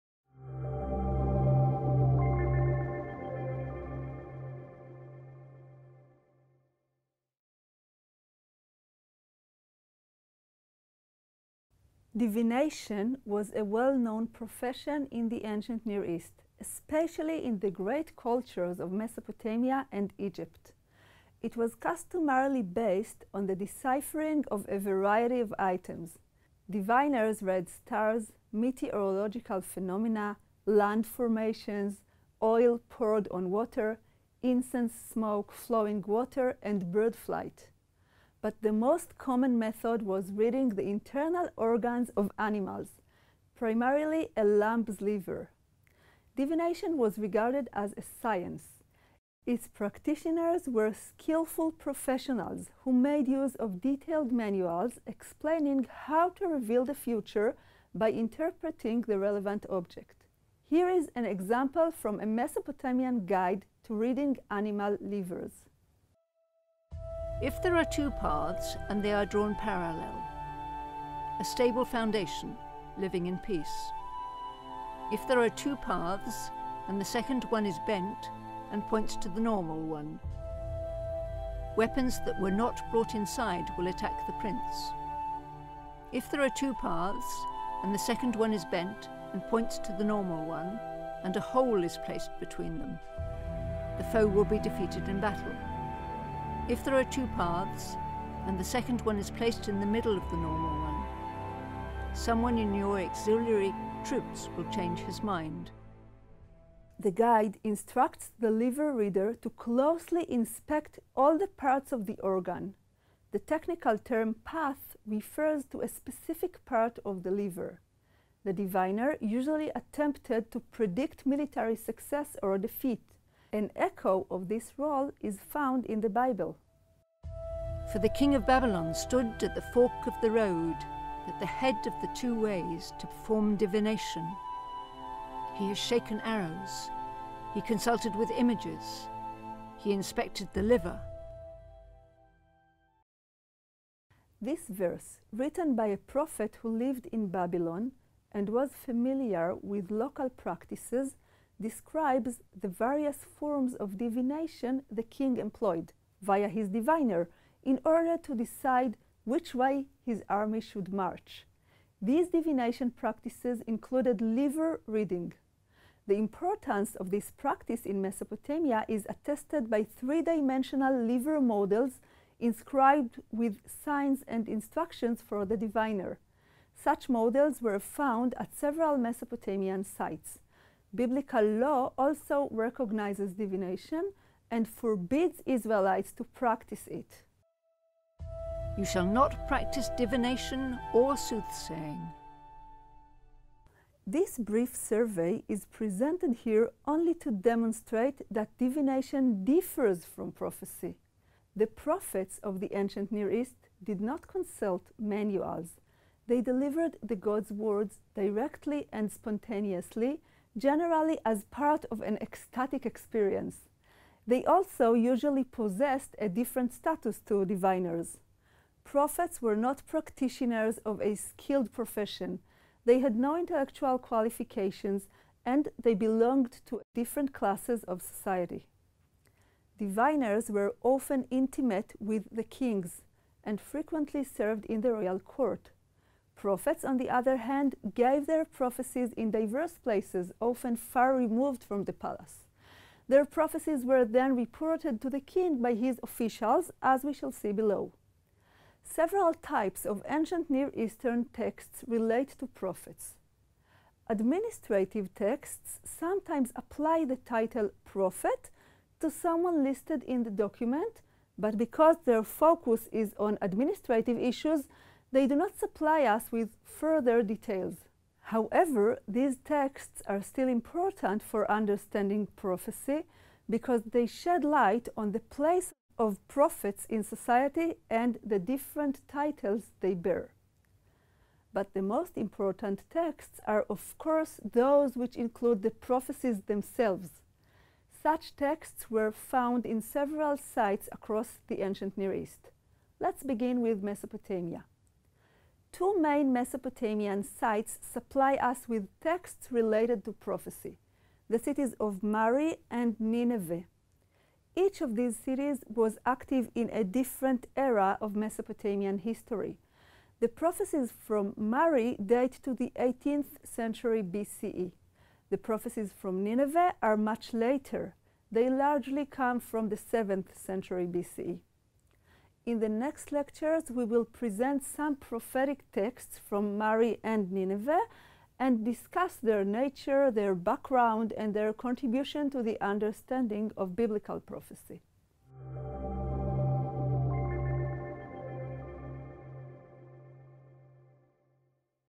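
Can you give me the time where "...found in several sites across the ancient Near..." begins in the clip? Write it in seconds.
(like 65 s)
289 s.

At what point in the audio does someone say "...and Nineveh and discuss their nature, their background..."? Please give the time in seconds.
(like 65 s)
327 s.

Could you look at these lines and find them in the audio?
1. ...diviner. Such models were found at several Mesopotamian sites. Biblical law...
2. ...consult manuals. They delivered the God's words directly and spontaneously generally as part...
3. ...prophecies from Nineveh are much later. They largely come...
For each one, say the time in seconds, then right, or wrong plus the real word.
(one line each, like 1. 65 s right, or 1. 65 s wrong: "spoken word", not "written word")
1. 175 s right
2. 204 s right
3. 315 s right.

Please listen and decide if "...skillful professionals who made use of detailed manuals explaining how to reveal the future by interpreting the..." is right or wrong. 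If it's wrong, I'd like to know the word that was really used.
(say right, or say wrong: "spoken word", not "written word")
right.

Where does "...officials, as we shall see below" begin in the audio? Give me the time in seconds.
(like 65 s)
246 s.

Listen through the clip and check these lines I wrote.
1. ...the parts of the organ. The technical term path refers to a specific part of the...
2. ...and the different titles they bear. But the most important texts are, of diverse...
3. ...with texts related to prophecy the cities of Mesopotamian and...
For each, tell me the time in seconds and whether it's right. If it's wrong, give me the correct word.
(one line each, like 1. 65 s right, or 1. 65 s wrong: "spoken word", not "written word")
1. 111 s right
2. 277 s wrong: "course", not "diverse"
3. 298 s wrong: "Mari", not "Mesopotamian".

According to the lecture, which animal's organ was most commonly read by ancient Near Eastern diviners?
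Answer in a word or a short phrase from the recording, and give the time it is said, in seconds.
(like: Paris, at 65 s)
Lamb's liver, at 44 s.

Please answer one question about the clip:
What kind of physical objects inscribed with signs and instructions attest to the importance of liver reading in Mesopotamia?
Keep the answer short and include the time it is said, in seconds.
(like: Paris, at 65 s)
Three dimensional liver models, at 169 s.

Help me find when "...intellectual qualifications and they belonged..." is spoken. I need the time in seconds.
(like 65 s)
223 s.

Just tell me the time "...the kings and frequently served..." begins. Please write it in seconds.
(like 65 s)
232 s.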